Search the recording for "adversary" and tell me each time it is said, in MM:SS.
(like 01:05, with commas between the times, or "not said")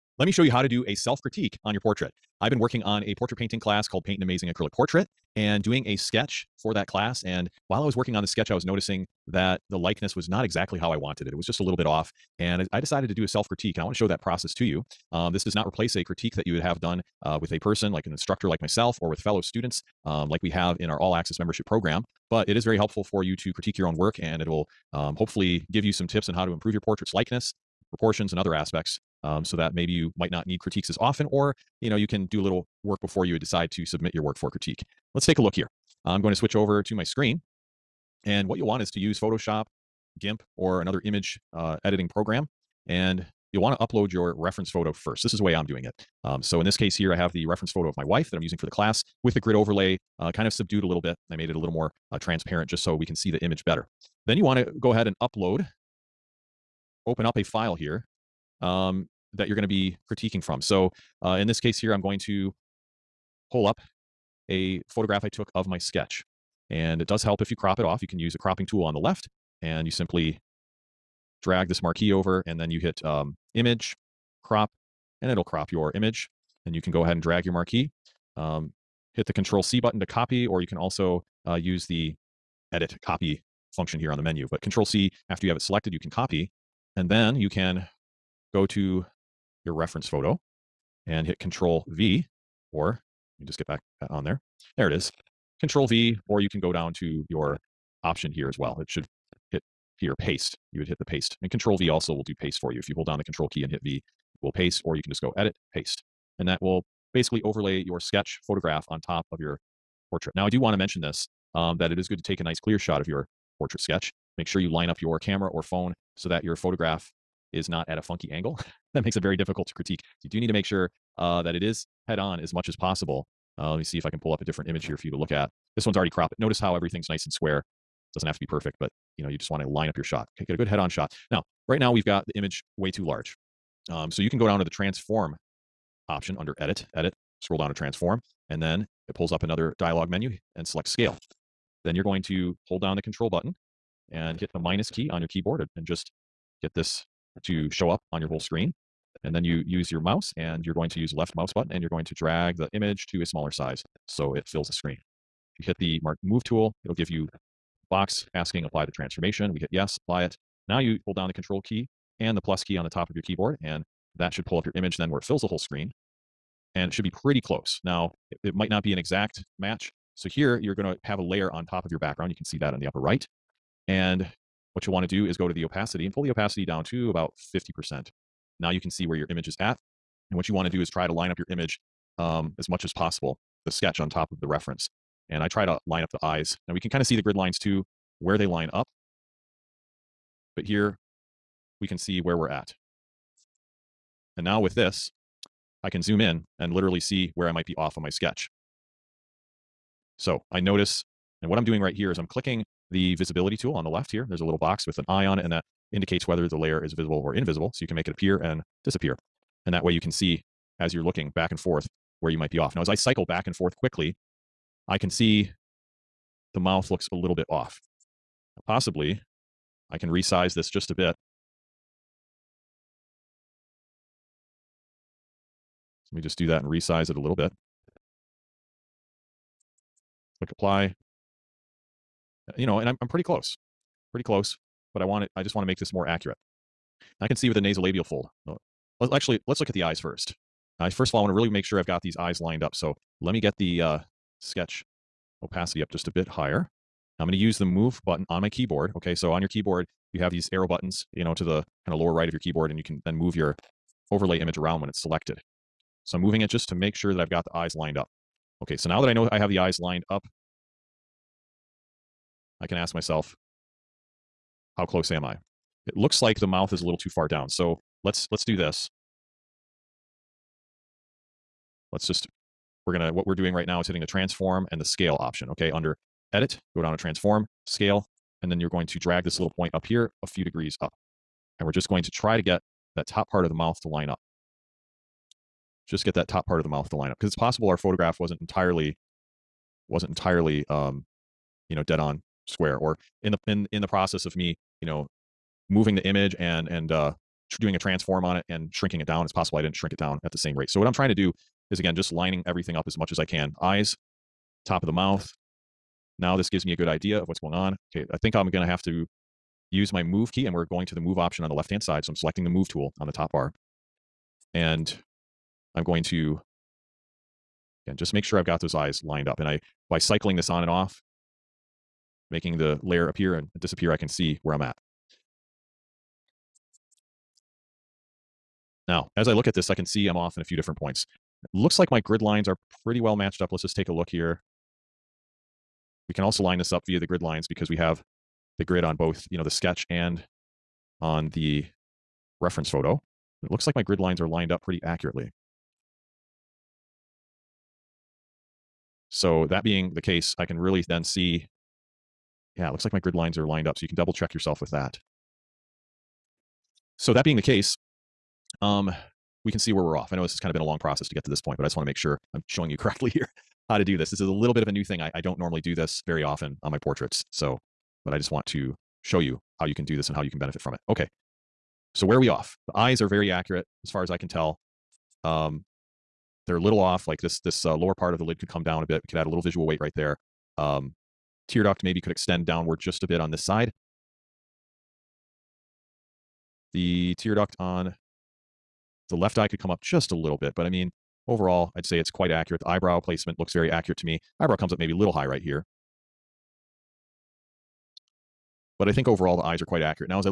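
not said.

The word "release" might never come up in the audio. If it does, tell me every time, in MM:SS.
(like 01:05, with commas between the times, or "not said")
not said.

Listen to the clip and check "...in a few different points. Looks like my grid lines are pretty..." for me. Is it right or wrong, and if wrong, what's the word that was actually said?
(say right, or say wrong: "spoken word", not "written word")
right.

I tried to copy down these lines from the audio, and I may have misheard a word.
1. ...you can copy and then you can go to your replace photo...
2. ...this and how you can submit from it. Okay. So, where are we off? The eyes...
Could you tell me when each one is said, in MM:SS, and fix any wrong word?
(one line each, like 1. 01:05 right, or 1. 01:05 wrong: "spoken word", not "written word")
1. 01:25 wrong: "reference", not "replace"
2. 06:09 wrong: "benefit", not "submit".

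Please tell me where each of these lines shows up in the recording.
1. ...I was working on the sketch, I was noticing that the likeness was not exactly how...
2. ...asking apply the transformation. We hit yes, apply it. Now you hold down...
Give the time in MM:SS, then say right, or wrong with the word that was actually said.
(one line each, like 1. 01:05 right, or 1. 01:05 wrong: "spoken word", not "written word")
1. 00:07 right
2. 02:38 right.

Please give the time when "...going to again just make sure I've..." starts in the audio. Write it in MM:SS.
05:15.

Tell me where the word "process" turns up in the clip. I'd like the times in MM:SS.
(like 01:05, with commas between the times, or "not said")
00:14, 04:53, 06:00.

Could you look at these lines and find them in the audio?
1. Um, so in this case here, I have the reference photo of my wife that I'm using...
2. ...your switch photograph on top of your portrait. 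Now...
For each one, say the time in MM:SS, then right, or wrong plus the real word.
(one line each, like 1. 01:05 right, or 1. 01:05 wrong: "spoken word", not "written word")
1. 00:46 right
2. 01:47 wrong: "sketch", not "switch".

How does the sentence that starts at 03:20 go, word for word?
So I notice, and what I'm doing right here is I'm clicking the visibility tool on the left here.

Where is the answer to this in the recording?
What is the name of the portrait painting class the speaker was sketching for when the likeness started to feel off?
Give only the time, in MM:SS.
00:04.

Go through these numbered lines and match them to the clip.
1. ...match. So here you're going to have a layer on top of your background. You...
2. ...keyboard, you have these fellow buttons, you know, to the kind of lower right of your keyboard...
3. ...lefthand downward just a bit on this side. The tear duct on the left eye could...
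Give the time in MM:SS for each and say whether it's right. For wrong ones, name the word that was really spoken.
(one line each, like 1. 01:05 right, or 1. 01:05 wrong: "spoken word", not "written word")
1. 02:49 right
2. 04:09 wrong: "arrow", not "fellow"
3. 06:22 wrong: "extend", not "lefthand".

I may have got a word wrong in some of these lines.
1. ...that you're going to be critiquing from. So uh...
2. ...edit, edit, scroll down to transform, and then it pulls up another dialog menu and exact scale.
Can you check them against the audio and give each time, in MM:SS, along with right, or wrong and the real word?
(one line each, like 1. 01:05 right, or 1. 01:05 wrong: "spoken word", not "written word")
1. 00:59 right
2. 02:16 wrong: "select", not "exact".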